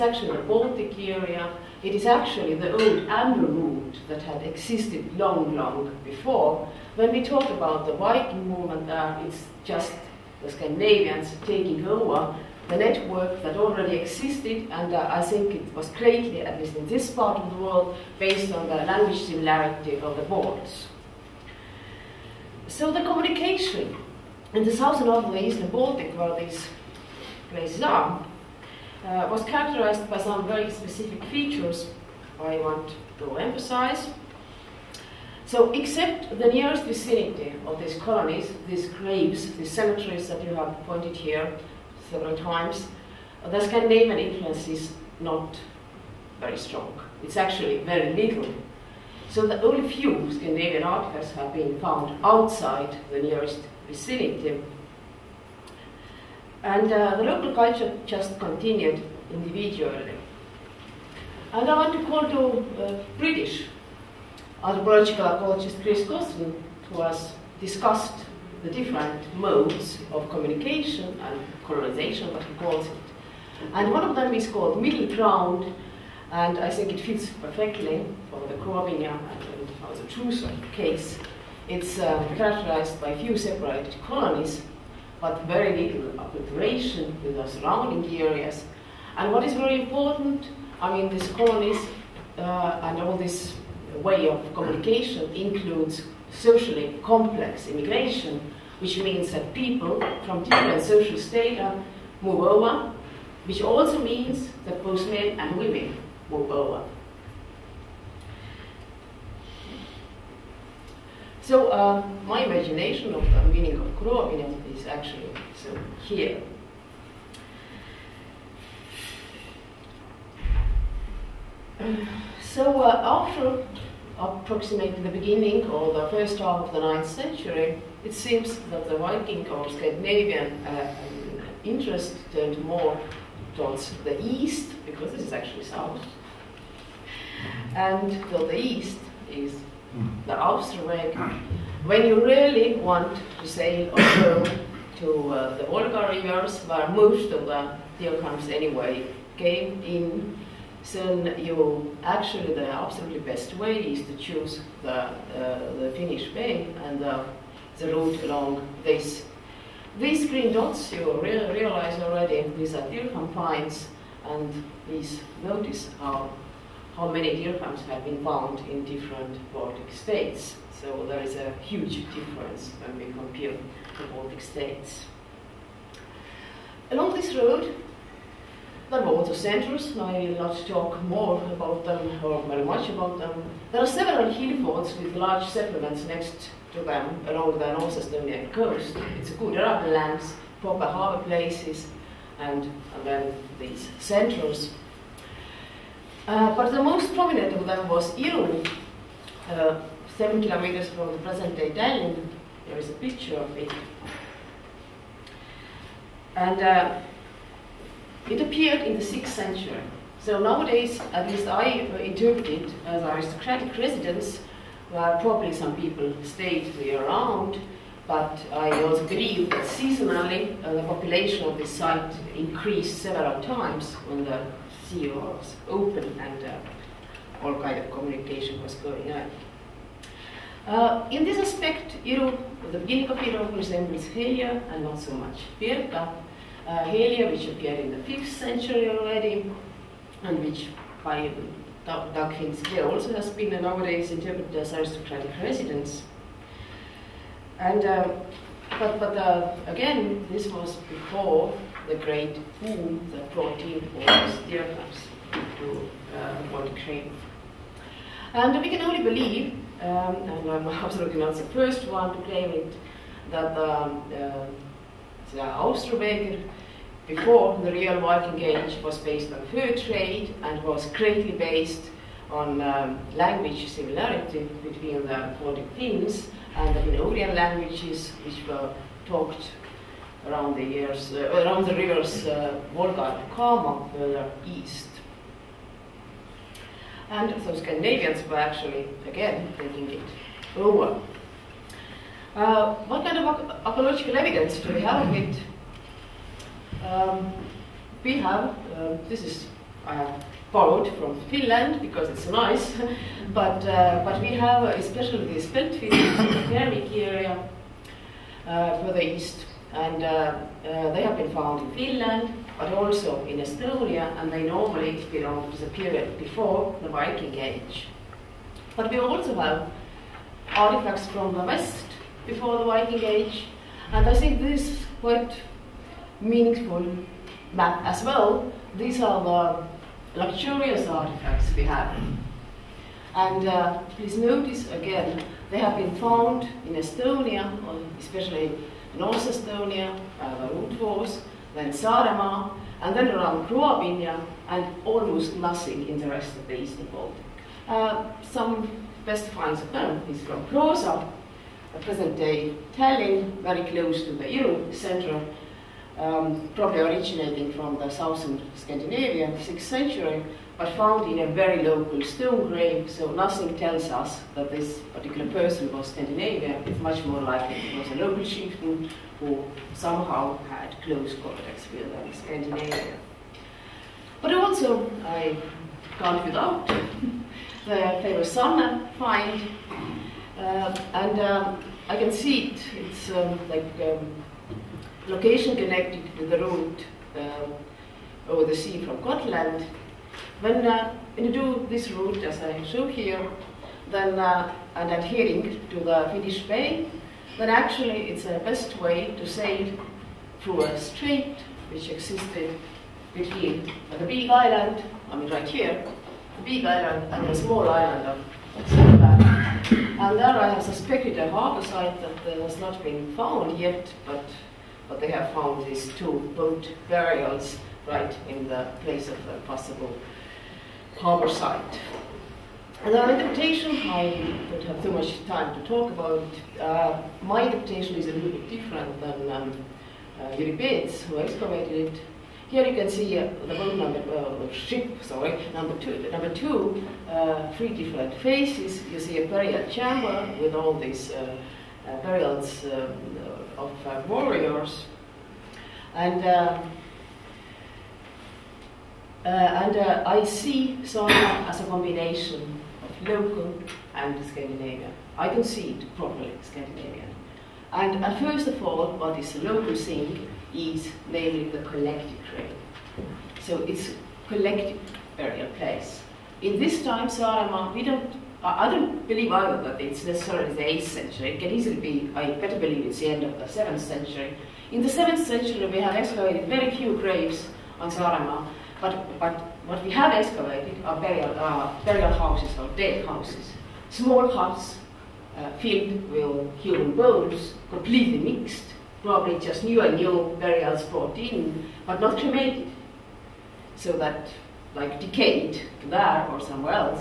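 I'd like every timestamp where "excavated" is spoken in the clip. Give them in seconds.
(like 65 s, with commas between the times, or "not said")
431 s, 475 s, 480 s.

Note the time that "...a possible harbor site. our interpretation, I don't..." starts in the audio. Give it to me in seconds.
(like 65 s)
419 s.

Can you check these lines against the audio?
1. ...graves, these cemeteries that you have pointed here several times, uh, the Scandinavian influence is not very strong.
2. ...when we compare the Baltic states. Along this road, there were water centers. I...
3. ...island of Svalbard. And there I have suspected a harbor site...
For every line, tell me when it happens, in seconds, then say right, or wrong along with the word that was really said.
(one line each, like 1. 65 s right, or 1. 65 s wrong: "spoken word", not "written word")
1. 38 s right
2. 172 s right
3. 407 s right.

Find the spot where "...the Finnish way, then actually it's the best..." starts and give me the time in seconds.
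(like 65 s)
395 s.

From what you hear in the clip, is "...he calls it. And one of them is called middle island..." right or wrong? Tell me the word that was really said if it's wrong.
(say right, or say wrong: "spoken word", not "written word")
wrong: "ground", not "island".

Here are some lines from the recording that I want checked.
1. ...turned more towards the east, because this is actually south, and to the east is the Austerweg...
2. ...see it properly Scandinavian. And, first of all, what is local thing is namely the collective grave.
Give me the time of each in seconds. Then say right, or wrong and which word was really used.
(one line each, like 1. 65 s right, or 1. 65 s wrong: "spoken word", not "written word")
1. 132 s right
2. 455 s right.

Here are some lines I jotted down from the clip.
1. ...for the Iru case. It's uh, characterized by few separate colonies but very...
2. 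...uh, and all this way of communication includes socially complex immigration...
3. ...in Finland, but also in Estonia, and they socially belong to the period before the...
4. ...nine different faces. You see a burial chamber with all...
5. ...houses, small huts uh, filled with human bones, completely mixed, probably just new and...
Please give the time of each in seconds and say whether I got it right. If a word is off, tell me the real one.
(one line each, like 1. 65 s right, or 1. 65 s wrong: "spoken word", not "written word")
1. 79 s wrong: "Truso", not "Iru"
2. 92 s right
3. 311 s wrong: "normally", not "socially"
4. 437 s wrong: "three", not "nine"
5. 483 s right.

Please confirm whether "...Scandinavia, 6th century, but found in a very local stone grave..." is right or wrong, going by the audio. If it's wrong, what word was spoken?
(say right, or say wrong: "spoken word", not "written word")
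right.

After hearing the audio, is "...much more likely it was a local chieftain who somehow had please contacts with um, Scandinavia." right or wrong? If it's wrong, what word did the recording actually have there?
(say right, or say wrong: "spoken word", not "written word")
wrong: "close", not "please".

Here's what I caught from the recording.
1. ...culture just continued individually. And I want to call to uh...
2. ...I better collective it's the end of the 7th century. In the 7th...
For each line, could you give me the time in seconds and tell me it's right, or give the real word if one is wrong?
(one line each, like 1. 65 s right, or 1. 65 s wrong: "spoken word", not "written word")
1. 57 s right
2. 472 s wrong: "believe", not "collective".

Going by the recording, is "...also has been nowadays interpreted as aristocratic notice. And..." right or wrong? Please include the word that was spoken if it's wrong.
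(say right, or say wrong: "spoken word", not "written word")
wrong: "residence", not "notice".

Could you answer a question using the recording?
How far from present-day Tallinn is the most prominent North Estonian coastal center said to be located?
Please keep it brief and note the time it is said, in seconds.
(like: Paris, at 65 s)
7 kilometers, at 200 s.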